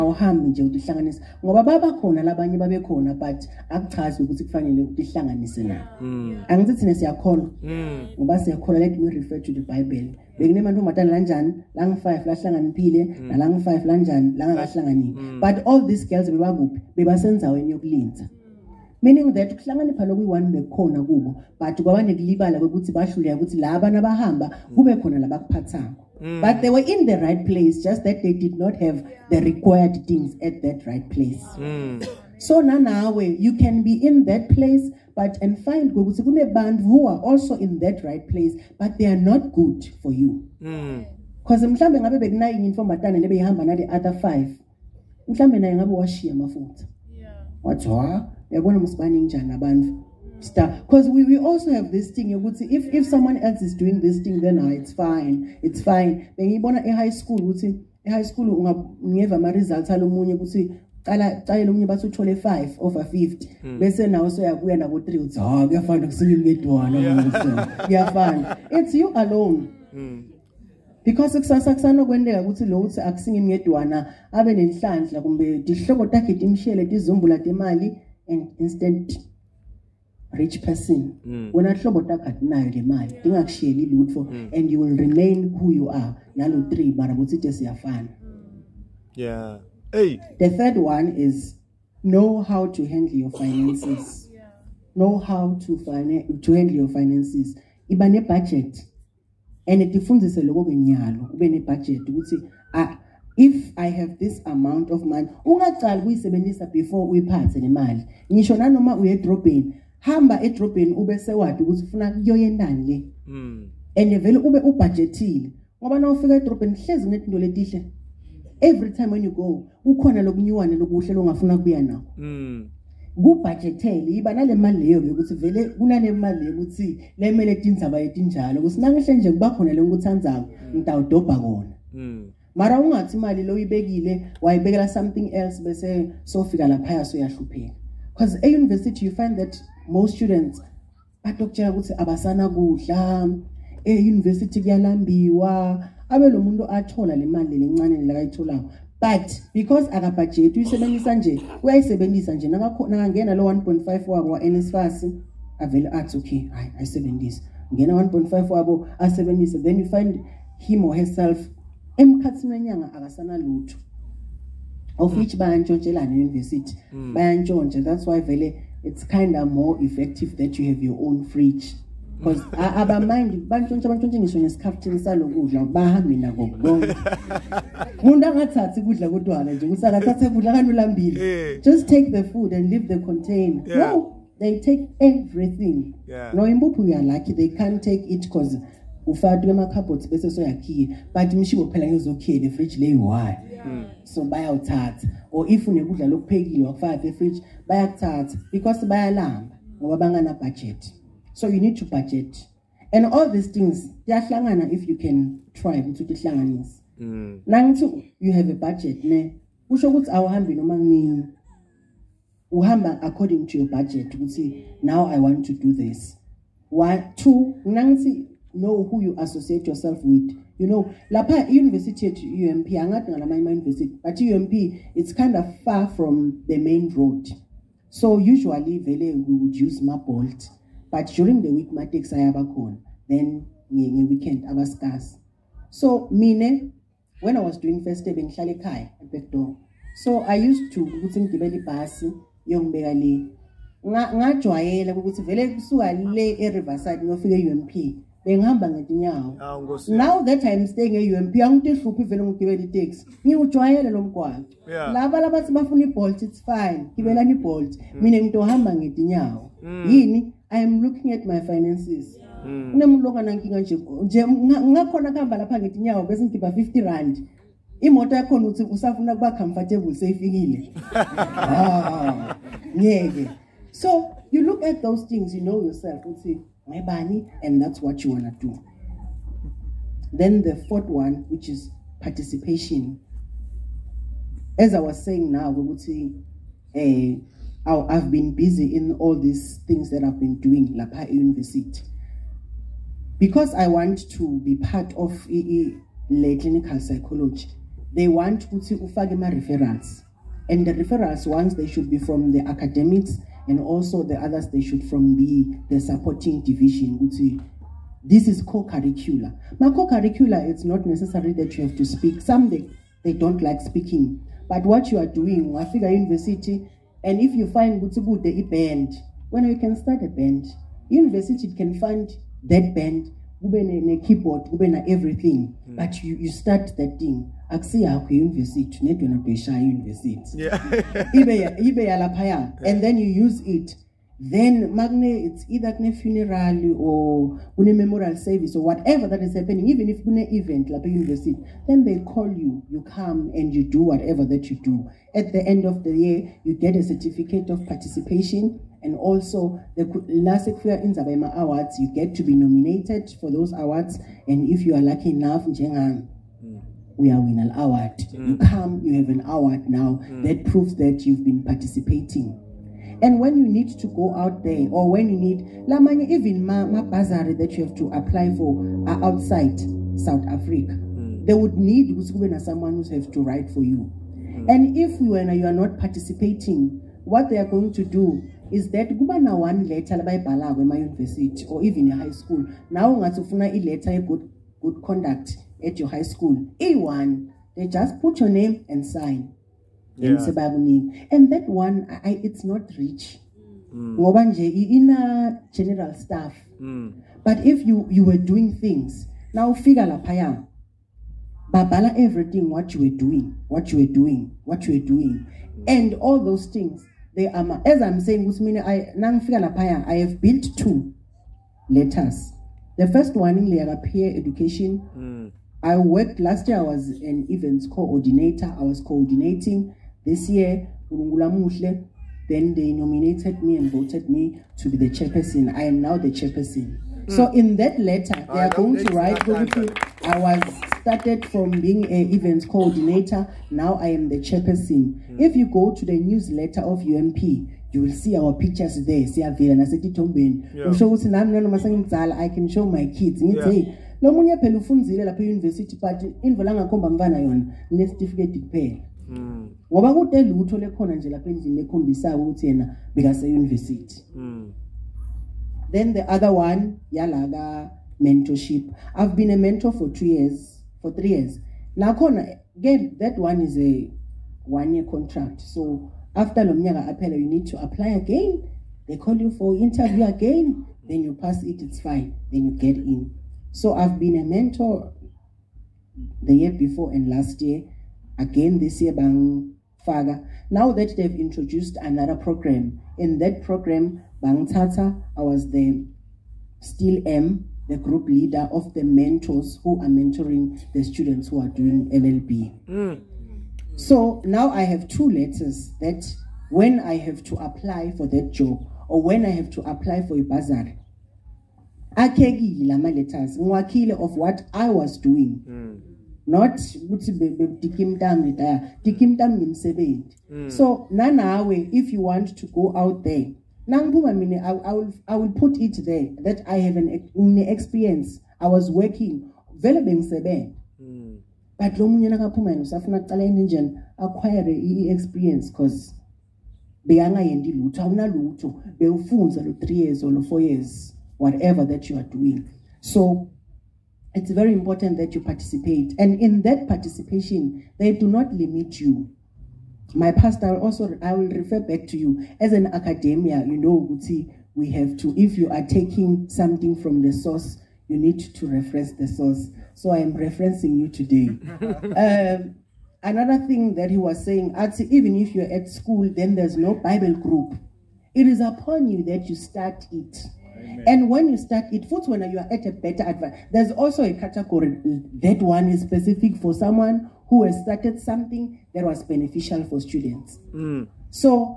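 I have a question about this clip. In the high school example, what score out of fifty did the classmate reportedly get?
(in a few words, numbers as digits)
5.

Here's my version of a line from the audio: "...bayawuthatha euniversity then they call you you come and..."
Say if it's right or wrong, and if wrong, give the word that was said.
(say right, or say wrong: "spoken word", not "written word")
wrong: "lapha", not "bayawuthatha".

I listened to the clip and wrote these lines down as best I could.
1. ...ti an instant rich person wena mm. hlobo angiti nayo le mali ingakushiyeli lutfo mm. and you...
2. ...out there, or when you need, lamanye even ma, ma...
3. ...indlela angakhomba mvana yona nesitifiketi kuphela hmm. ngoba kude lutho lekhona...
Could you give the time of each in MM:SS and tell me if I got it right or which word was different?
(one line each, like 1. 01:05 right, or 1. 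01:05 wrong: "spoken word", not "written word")
1. 01:17 wrong: "takati", not "angiti"
2. 06:04 right
3. 07:26 right.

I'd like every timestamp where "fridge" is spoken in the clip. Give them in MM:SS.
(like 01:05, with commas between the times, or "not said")
02:51, 03:12, 03:17.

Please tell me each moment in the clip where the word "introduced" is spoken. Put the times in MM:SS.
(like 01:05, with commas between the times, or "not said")
08:01.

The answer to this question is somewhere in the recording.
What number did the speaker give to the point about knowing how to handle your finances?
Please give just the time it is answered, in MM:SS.
01:30.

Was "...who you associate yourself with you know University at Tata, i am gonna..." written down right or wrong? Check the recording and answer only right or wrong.
wrong.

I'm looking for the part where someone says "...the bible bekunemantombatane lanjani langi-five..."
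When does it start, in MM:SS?
00:09.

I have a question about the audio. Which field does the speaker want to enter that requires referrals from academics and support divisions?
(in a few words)
clinical psychology.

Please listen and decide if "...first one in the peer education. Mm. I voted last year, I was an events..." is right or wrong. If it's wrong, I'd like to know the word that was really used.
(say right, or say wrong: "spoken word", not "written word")
wrong: "worked", not "voted".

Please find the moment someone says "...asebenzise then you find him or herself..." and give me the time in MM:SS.
02:38.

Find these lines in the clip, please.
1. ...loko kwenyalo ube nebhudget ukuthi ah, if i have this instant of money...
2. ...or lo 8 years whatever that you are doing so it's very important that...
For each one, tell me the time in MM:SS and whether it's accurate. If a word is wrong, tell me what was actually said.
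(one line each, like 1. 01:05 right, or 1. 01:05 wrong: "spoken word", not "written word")
1. 01:40 wrong: "amount", not "instant"
2. 08:50 wrong: "4", not "8".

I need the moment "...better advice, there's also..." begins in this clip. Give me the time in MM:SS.
09:22.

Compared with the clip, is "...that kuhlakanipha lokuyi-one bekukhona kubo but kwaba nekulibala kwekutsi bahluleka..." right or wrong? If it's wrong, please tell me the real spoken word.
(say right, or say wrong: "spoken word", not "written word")
right.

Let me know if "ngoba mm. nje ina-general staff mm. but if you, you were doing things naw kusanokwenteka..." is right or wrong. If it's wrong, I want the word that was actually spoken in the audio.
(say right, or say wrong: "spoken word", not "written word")
wrong: "ufika", not "kusanokwenteka".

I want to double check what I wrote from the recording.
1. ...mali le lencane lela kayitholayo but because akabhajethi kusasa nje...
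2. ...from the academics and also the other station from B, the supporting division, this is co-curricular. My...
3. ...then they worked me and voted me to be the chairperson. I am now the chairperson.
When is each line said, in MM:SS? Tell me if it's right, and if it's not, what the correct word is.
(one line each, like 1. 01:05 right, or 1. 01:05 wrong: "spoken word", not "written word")
1. 02:27 wrong: "uyisebenzisa", not "kusasa"
2. 05:01 right
3. 07:00 wrong: "nominated", not "worked".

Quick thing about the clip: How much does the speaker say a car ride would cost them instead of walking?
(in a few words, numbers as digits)
R50.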